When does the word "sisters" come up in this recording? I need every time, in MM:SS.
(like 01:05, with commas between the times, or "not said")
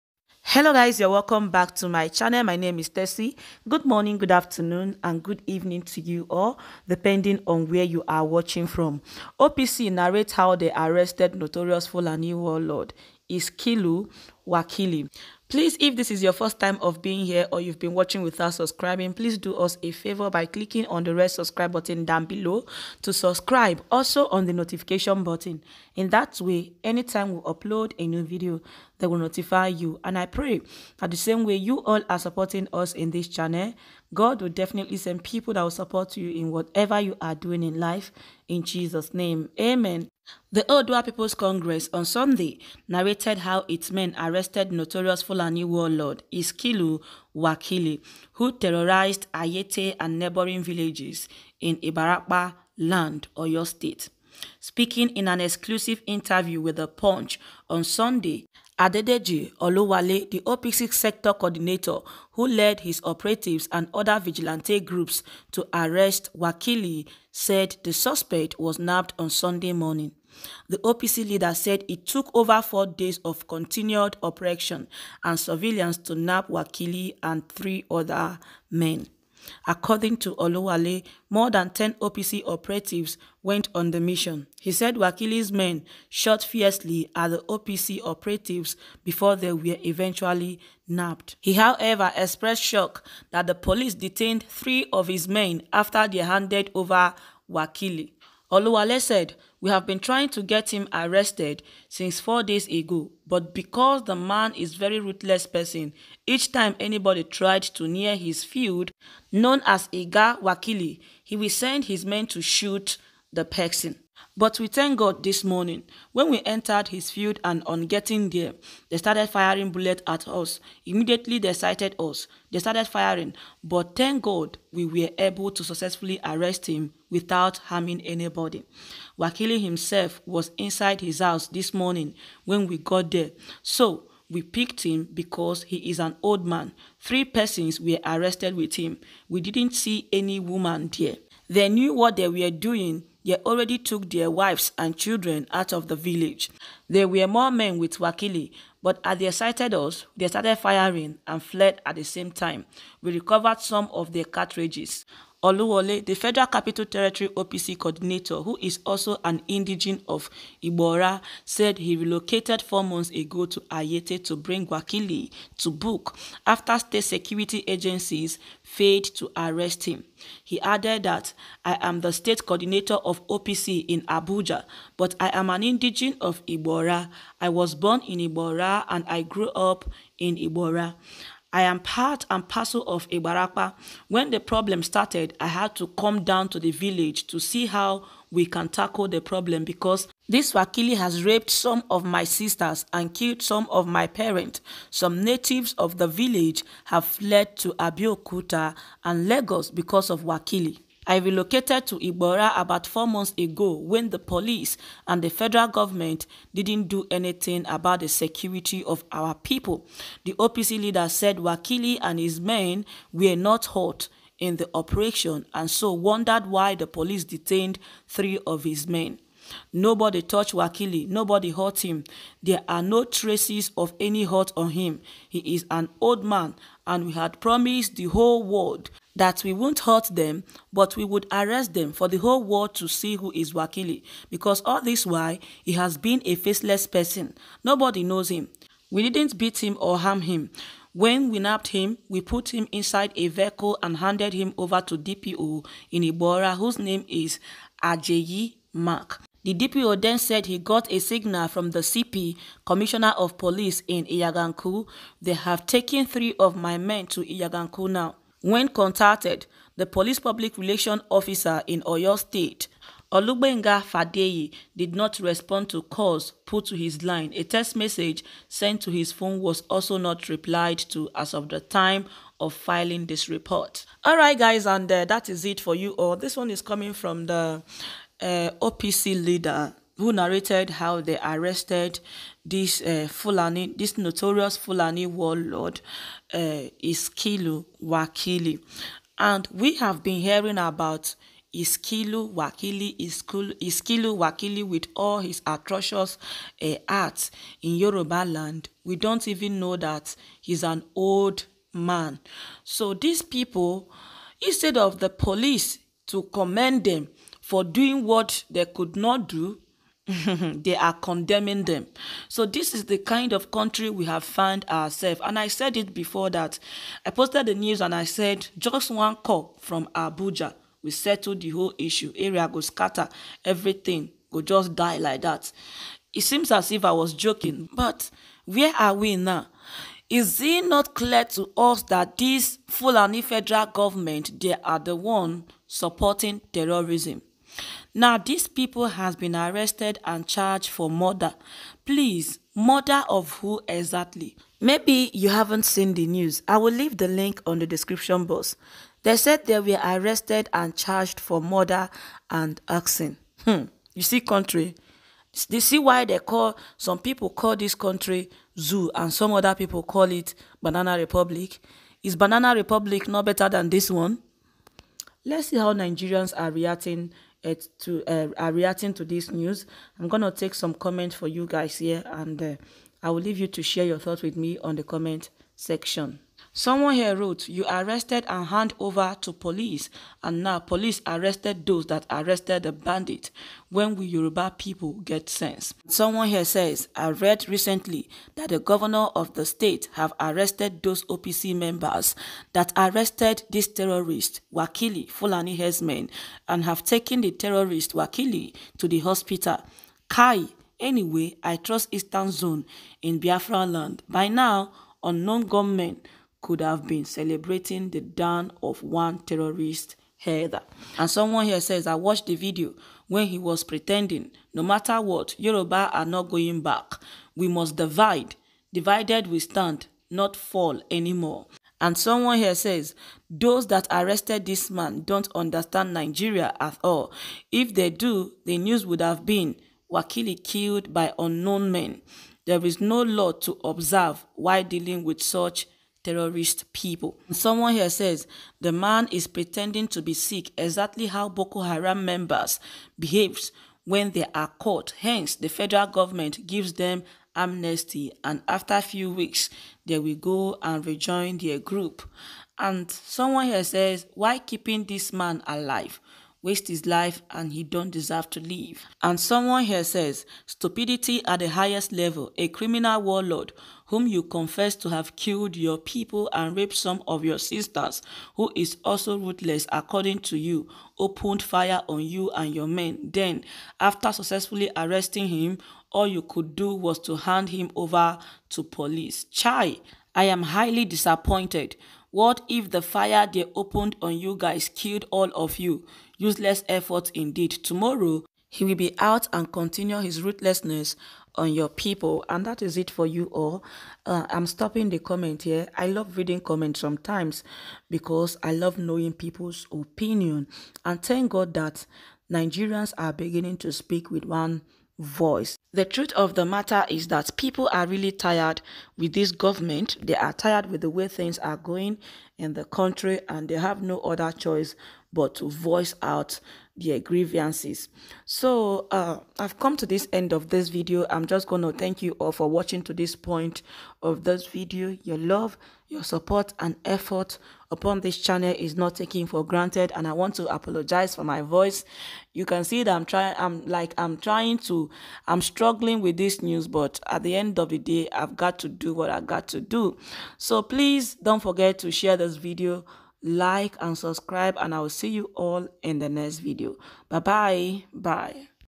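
03:12, 07:47.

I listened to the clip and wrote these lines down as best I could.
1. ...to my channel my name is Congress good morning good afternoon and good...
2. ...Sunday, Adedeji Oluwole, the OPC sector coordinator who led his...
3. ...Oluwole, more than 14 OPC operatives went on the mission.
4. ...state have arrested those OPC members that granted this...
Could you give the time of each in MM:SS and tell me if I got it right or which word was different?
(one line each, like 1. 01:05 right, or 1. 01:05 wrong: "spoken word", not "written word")
1. 00:01 wrong: "Tessie", not "Congress"
2. 00:57 right
3. 01:20 wrong: "10", not "14"
4. 06:29 wrong: "arrested", not "granted".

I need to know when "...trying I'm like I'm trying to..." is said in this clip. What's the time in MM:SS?
08:53.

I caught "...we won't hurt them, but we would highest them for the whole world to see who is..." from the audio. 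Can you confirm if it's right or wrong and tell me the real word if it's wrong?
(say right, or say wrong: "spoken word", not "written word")
wrong: "arrest", not "highest".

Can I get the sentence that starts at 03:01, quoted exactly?
I am part and parcel of Ibarapa.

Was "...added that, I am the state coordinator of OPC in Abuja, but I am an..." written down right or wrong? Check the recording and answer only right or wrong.
right.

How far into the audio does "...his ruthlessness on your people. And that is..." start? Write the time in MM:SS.
08:10.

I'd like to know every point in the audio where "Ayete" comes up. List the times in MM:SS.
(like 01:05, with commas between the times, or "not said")
00:49, 02:43.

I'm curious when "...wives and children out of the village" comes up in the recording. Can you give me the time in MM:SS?
02:24.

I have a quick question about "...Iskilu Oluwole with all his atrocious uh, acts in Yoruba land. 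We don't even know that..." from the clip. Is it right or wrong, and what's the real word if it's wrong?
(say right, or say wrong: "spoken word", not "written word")
wrong: "Wakili", not "Oluwole".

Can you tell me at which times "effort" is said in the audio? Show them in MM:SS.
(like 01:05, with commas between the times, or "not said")
08:06, 08:46.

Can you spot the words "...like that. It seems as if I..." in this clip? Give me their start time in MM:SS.
05:24.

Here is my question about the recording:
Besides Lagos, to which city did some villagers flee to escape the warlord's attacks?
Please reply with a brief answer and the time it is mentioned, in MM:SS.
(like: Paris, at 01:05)
Abeokuta, at 03:17.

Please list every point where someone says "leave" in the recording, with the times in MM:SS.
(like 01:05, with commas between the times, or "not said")
05:46, 06:13.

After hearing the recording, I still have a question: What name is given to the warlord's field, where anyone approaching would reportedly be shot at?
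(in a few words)
Iga Wakili.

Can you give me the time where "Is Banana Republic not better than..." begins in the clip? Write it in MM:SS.
06:02.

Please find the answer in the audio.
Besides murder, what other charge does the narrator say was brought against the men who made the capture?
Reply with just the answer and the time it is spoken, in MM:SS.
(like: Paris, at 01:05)
Arson, at 05:52.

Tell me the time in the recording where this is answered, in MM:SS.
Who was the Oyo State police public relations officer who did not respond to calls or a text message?
04:23.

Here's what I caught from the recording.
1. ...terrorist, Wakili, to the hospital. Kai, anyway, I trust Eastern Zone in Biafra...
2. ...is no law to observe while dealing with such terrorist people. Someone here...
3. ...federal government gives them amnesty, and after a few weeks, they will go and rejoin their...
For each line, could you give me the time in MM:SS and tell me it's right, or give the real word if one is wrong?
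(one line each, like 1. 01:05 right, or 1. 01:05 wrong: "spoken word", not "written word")
1. 06:37 right
2. 07:12 right
3. 07:25 right.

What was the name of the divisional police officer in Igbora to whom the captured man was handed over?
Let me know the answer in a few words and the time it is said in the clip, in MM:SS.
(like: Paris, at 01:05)
Ajayi Mark, at 04:07.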